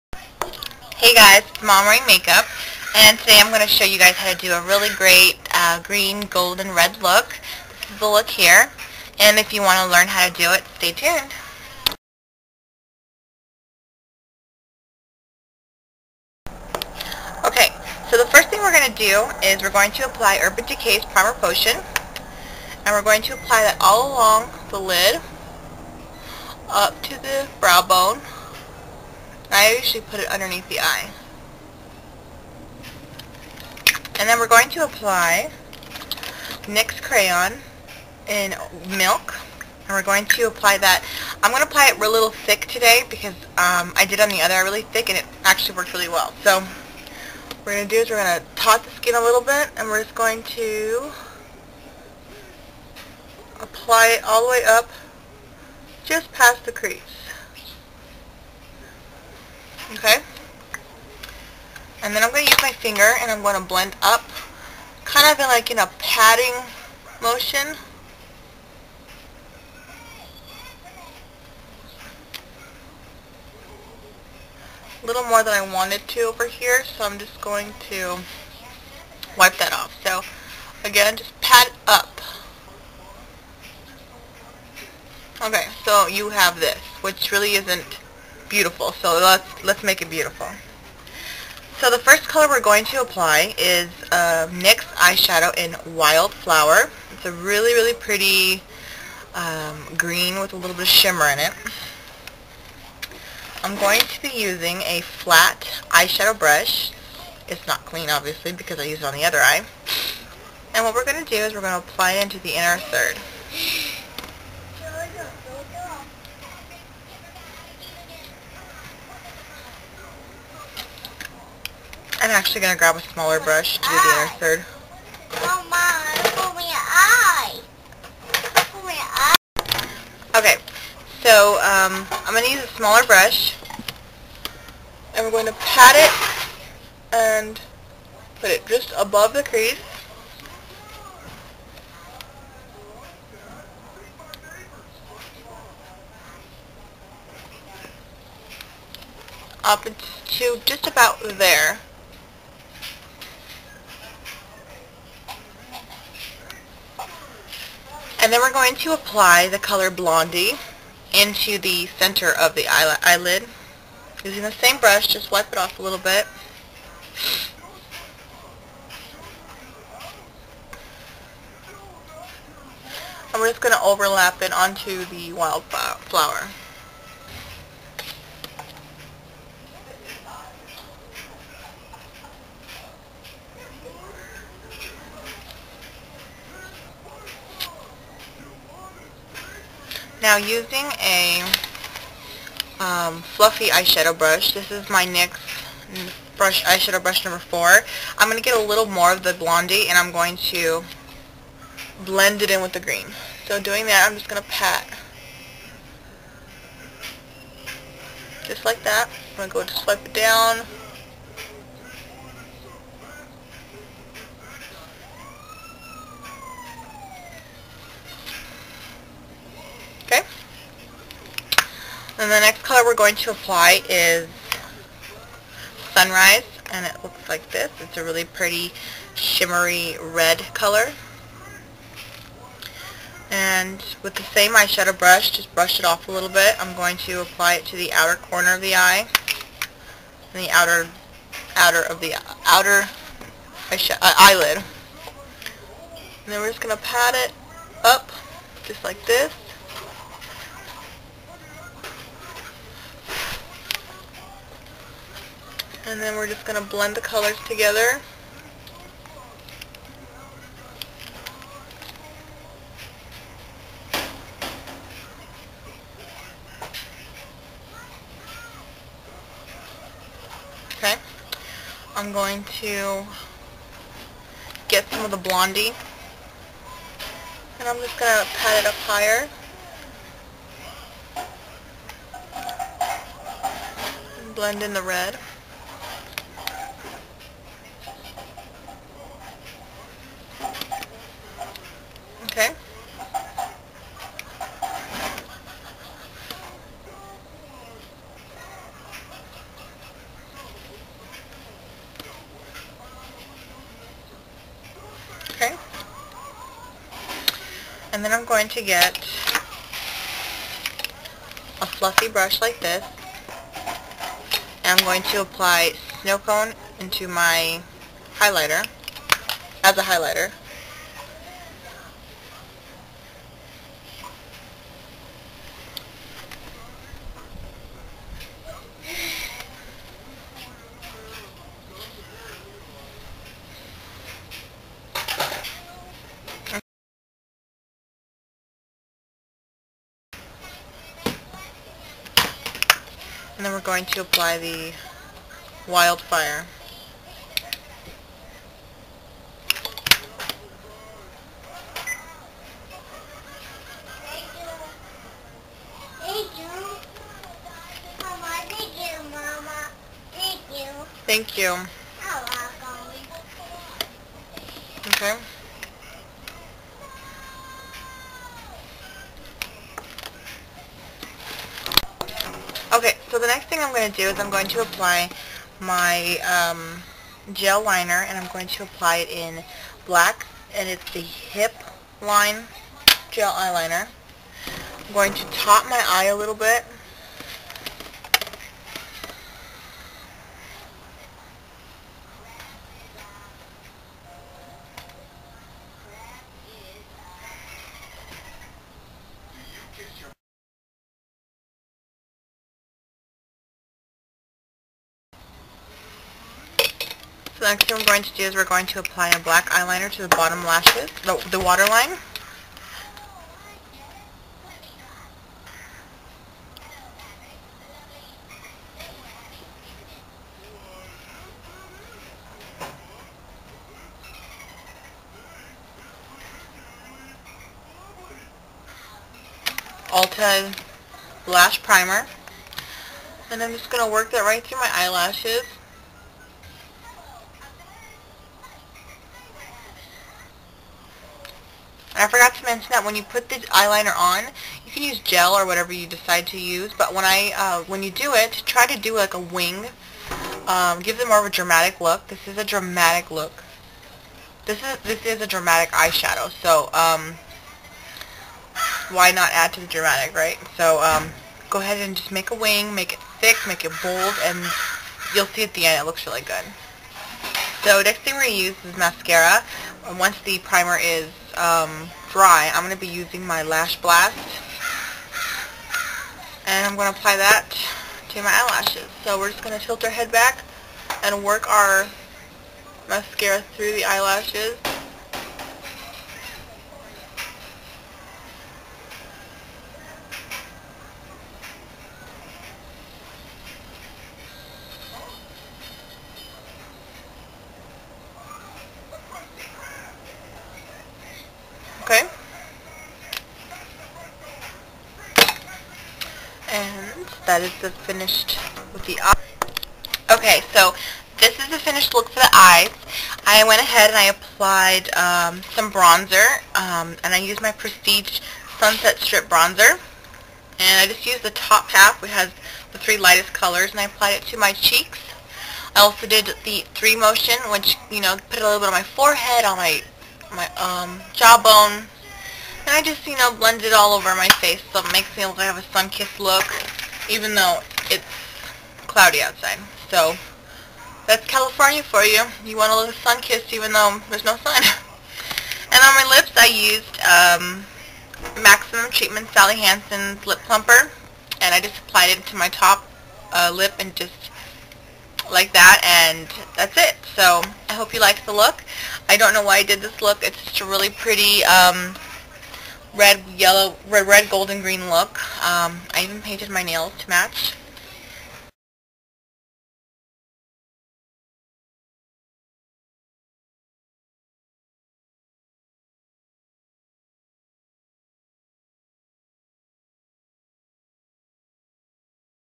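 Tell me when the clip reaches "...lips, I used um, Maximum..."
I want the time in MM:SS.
09:06.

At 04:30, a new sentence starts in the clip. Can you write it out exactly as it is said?
Okay, I'm going to get some of the blondie and I'm just going to pat it up higher.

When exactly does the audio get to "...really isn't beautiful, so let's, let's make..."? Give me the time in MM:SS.
01:27.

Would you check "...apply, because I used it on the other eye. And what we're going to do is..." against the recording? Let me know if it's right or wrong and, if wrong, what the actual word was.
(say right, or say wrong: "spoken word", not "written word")
wrong: "obviously", not "apply".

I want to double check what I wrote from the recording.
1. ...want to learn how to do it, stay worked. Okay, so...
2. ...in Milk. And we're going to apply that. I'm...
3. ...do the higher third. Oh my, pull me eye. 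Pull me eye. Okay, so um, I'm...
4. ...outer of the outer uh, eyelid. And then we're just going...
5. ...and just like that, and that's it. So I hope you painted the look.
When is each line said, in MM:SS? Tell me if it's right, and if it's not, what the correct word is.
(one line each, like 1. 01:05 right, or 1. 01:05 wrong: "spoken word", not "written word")
1. 00:09 wrong: "tuned", not "worked"
2. 00:38 right
3. 02:03 wrong: "inner", not "higher"
4. 04:01 right
5. 09:13 wrong: "liked", not "painted".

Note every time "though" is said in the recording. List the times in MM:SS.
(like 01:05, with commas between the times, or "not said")
08:57, 09:03.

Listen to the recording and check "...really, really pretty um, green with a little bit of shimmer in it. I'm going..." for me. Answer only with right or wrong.
right.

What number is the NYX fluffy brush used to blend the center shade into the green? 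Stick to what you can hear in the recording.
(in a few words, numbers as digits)
4.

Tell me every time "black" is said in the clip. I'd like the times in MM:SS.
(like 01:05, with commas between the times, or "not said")
06:19, 06:49.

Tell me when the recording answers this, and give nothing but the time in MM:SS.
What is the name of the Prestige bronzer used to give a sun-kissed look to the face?
08:38.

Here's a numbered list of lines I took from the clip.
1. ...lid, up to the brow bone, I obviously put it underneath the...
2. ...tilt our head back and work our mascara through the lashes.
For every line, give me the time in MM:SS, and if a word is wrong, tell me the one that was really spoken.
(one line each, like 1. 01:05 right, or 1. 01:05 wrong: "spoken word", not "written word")
1. 00:24 wrong: "usually", not "obviously"
2. 07:59 wrong: "eyelashes", not "lashes".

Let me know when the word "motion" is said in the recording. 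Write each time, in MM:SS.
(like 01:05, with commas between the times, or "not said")
01:07, 08:46.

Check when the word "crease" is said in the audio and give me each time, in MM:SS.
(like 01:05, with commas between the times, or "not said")
00:56, 02:19.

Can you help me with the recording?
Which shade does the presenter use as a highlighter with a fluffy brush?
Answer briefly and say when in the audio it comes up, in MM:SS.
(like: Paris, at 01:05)
Snow Cone, at 05:16.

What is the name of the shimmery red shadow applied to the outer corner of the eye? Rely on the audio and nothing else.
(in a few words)
Sunrise.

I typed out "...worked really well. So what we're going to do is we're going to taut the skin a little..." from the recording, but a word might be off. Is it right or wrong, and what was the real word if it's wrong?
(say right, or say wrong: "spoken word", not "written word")
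right.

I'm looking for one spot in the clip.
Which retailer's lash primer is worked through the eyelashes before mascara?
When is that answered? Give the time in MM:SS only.
07:09.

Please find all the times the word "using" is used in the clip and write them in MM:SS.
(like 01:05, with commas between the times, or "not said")
01:44, 02:44, 03:10, 07:52.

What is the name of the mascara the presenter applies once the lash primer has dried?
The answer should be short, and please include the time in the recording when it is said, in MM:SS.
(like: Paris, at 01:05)
Lash Blast, at 07:53.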